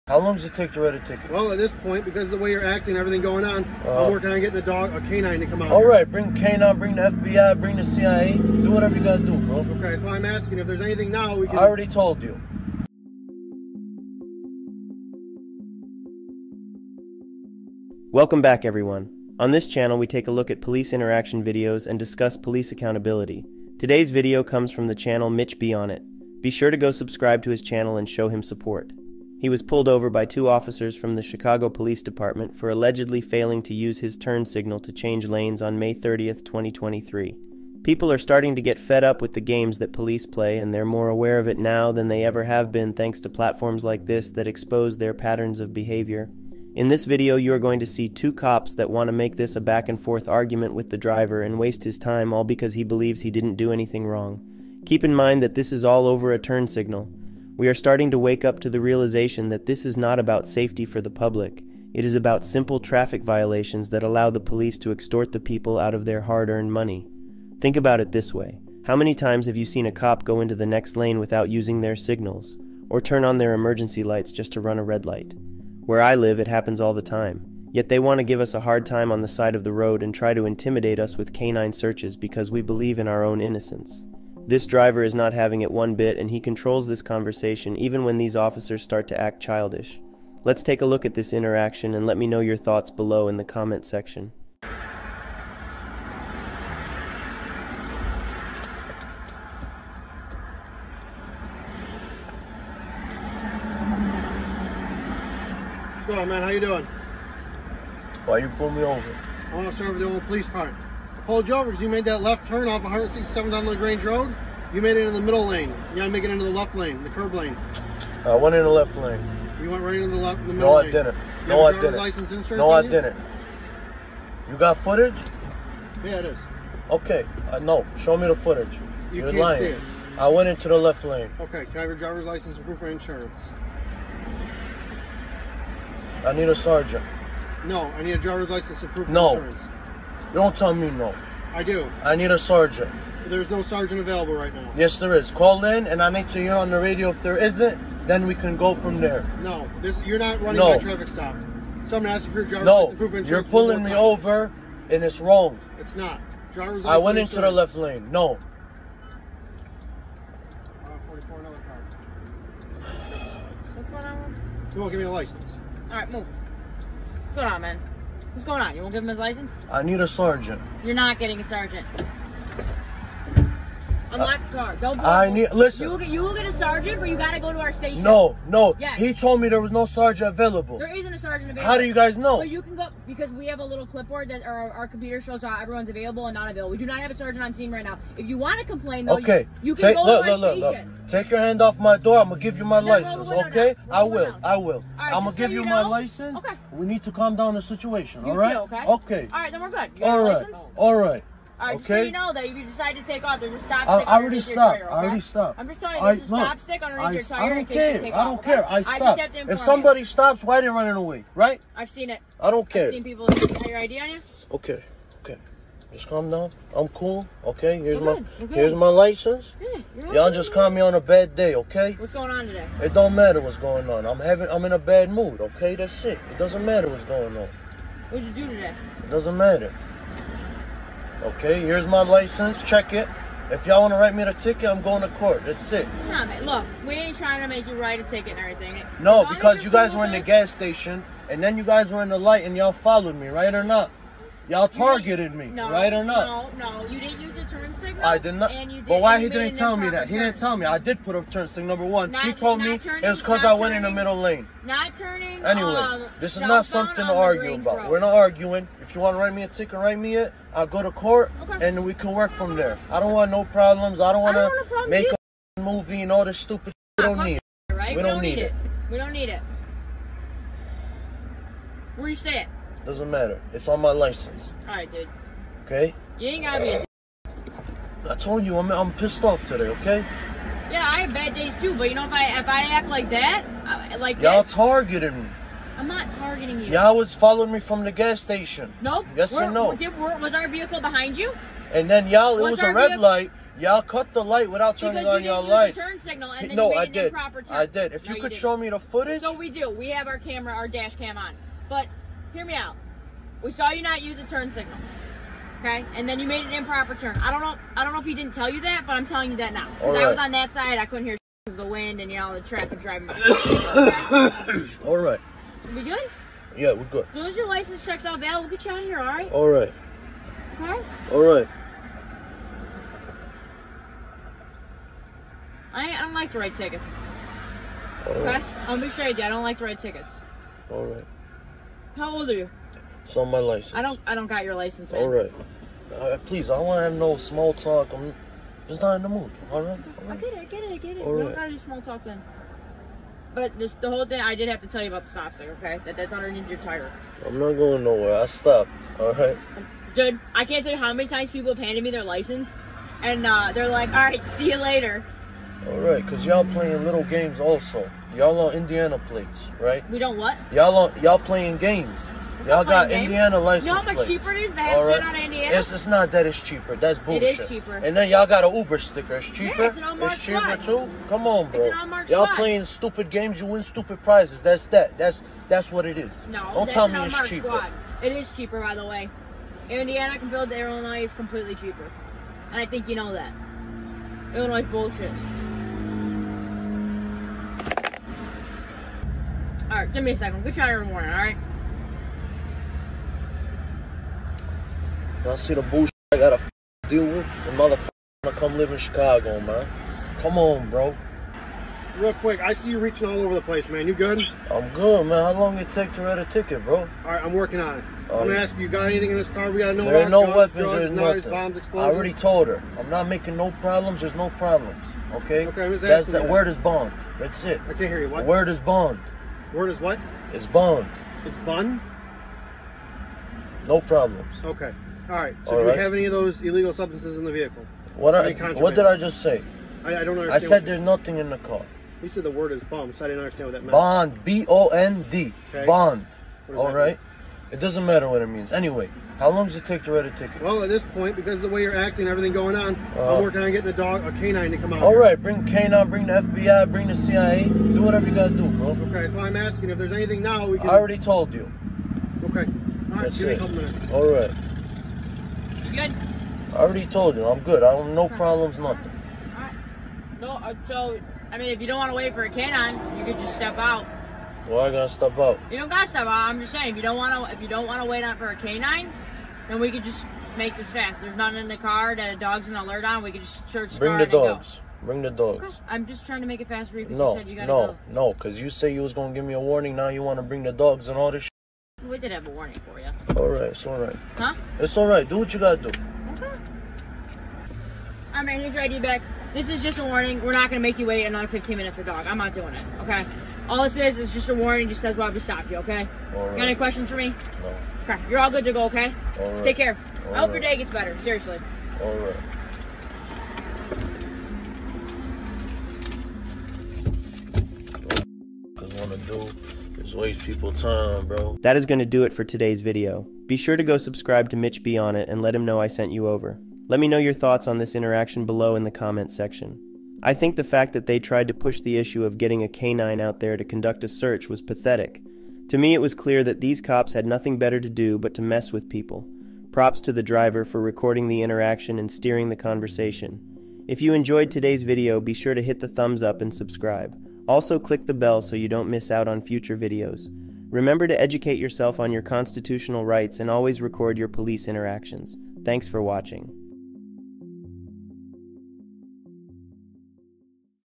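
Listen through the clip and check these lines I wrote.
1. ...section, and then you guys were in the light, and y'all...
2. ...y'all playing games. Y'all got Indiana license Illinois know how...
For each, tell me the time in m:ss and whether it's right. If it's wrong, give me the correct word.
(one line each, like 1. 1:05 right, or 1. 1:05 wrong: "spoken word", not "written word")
1. 4:00 wrong: "station", not "section"
2. 6:01 wrong: "You", not "Illinois".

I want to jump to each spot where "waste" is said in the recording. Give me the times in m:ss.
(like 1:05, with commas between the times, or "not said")
0:51, 8:29.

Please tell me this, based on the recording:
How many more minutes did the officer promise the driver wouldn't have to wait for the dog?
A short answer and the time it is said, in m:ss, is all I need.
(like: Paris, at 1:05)
15, at 8:11.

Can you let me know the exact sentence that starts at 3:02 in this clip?
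So you can go because we have a little clipboard that our, our computer shows how everyone's available and not available.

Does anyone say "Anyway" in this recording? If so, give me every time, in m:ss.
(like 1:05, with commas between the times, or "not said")
4:15, 7:18.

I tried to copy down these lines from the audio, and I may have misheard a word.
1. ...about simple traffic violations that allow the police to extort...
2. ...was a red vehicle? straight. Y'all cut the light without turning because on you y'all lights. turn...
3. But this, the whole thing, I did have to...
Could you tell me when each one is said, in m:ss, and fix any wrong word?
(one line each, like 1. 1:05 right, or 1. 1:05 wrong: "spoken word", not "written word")
1. 1:02 right
2. 4:52 wrong: "light", not "straight"
3. 5:43 right.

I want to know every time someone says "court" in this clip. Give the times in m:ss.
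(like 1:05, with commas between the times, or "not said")
3:55, 4:20.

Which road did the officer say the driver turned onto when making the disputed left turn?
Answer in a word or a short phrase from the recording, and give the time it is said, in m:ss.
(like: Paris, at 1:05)
LaGrange Road, at 1:53.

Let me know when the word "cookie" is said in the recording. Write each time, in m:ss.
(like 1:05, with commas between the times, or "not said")
not said.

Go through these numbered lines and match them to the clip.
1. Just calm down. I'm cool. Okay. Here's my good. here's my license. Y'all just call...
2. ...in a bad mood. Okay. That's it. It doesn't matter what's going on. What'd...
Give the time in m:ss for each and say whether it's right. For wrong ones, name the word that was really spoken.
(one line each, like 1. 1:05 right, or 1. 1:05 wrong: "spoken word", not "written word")
1. 3:35 right
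2. 3:44 right.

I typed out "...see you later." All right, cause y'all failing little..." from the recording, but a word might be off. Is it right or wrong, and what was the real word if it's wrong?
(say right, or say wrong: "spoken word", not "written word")
wrong: "playing", not "failing".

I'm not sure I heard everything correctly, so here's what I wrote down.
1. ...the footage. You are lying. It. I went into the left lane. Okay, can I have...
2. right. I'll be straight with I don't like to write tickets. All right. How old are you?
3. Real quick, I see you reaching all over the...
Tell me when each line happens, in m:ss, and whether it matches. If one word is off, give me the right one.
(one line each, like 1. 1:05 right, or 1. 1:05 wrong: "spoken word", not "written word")
1. 2:08 right
2. 5:28 right
3. 6:41 right.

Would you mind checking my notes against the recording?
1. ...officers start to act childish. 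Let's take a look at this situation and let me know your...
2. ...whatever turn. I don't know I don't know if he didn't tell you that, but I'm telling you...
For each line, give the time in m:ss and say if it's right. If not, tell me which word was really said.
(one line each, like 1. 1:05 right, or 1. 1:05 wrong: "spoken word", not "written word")
1. 1:28 wrong: "interaction", not "situation"
2. 5:06 wrong: "improper", not "whatever".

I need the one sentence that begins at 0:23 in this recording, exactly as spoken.
Today's video comes from the channel Mitch Be On It.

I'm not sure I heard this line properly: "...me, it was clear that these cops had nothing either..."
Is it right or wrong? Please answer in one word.
wrong.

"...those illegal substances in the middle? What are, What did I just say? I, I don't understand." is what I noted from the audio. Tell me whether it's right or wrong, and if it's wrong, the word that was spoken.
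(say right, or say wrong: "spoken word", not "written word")
wrong: "vehicle", not "middle".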